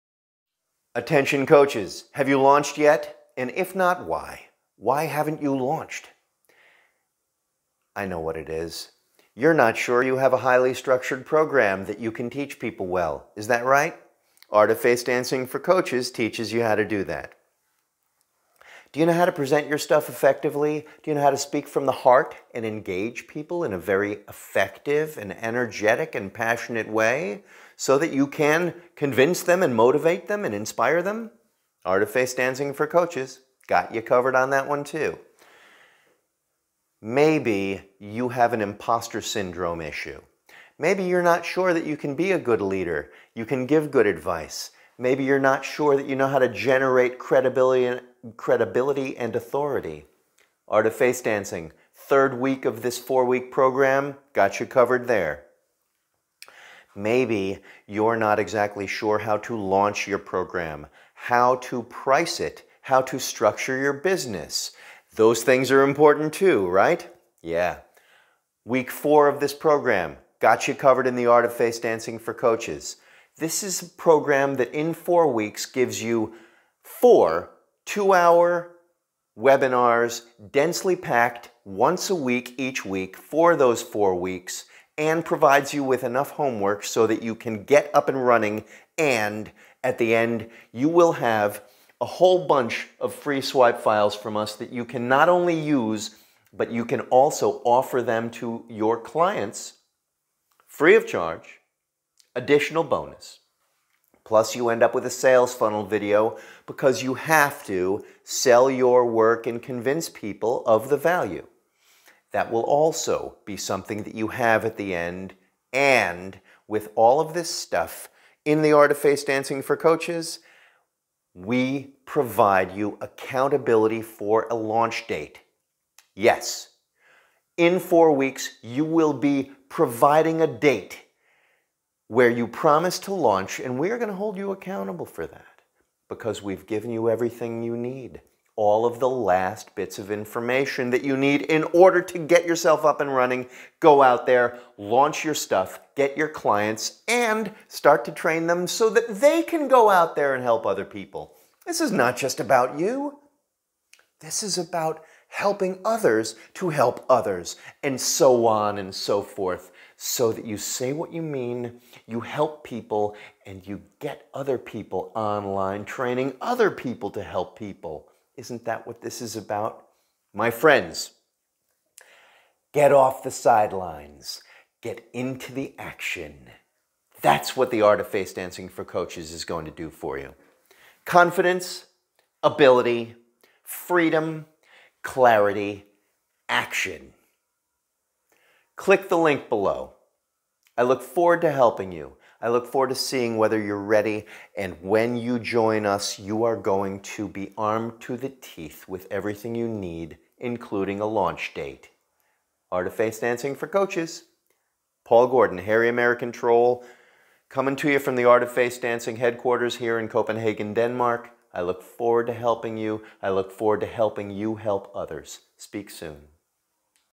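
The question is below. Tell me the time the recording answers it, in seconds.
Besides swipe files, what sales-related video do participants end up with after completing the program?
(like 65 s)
105 s.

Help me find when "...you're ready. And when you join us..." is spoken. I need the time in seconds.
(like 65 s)
193 s.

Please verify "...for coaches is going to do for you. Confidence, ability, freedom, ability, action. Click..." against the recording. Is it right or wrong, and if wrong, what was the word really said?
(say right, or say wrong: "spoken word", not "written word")
wrong: "clarity", not "ability".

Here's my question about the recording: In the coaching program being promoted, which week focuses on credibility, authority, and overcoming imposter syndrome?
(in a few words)
Third week.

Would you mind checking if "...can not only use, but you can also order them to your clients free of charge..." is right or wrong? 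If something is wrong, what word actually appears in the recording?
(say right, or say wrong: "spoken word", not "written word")
wrong: "offer", not "order".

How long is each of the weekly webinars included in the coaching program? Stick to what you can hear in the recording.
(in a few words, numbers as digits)
2 hours.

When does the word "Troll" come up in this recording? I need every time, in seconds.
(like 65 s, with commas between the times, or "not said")
206 s.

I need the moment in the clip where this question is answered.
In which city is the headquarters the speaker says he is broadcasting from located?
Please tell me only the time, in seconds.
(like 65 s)
210 s.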